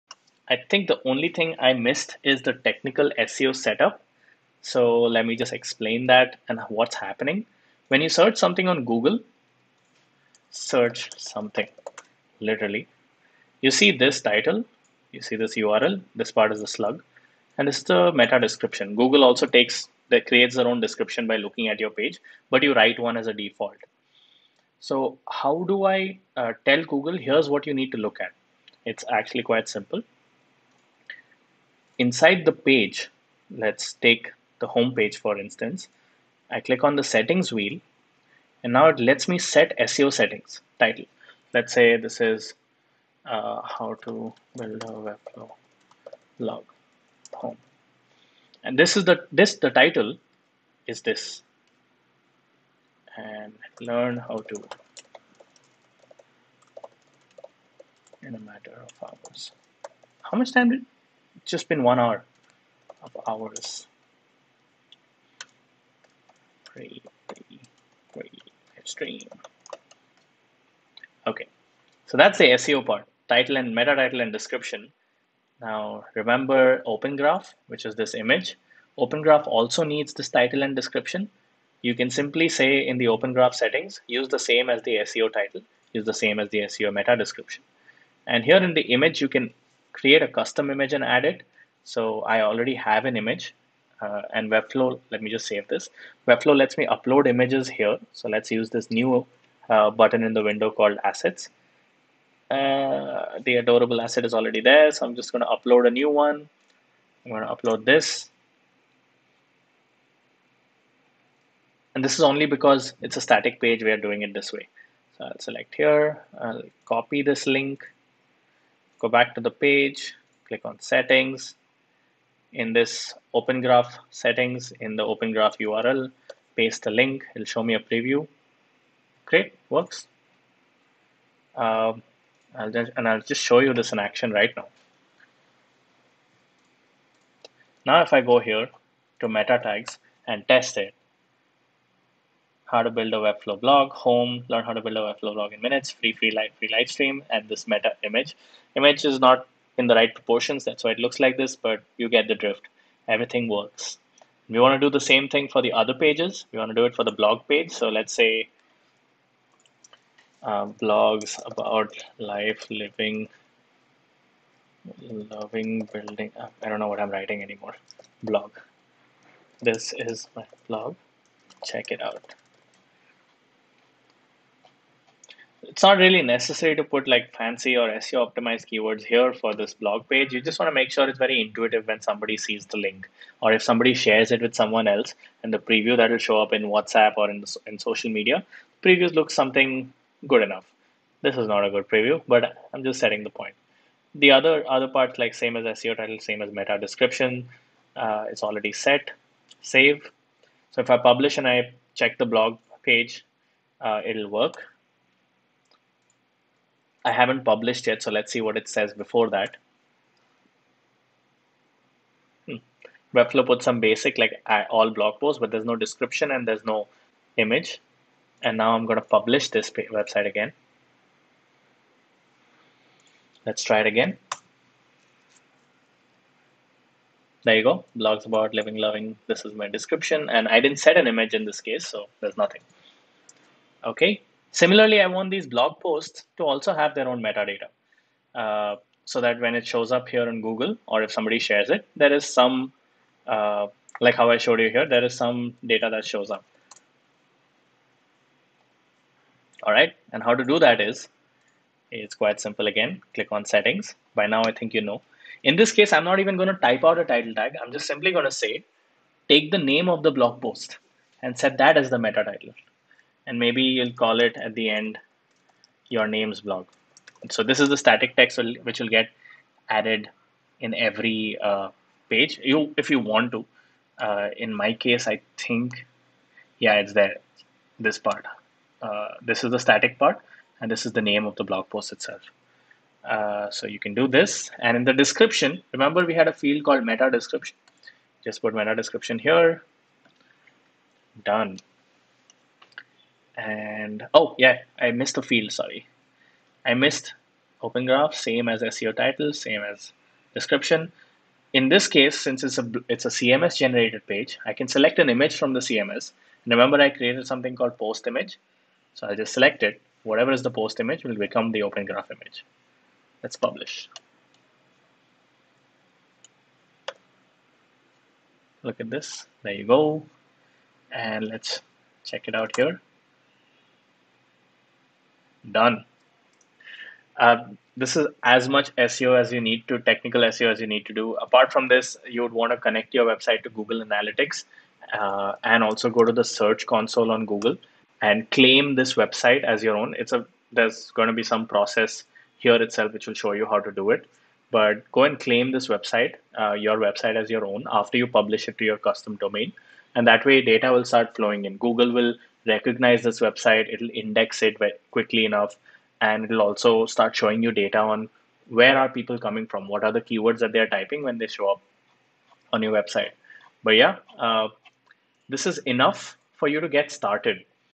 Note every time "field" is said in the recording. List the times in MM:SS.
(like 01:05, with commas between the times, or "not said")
04:46, 04:55.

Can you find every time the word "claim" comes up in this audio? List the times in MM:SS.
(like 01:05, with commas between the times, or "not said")
05:38, 05:45.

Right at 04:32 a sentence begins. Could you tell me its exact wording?
You, if you want to, uh, in my case, I think, yeah, it's there, this part.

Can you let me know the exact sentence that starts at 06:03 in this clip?
But yeah, uh, this is enough for you to get started.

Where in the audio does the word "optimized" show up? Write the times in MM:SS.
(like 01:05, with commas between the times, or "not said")
02:58.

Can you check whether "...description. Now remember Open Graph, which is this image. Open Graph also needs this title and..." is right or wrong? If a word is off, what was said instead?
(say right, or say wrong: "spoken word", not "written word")
right.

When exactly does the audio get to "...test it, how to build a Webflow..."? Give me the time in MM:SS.
02:20.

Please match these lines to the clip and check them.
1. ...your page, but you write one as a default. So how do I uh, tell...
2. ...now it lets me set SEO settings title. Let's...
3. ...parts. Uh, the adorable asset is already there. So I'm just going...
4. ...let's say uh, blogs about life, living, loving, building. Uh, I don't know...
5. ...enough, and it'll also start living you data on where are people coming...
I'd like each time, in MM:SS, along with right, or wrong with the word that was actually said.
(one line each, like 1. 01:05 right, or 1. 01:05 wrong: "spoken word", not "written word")
1. 00:21 right
2. 00:38 right
3. 01:41 wrong: "assets", not "parts"
4. 02:37 right
5. 05:55 wrong: "showing", not "living".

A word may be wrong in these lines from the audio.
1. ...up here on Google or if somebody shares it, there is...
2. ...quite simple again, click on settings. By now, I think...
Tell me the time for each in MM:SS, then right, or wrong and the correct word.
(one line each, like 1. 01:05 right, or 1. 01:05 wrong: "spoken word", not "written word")
1. 03:59 right
2. 04:12 right.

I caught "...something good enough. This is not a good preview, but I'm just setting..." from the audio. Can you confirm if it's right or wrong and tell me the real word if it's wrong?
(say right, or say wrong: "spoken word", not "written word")
right.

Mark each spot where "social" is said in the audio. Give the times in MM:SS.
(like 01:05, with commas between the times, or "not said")
03:07.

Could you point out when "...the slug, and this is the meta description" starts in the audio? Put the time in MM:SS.
00:16.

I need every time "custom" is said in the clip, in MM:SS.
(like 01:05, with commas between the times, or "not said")
01:30, 05:48.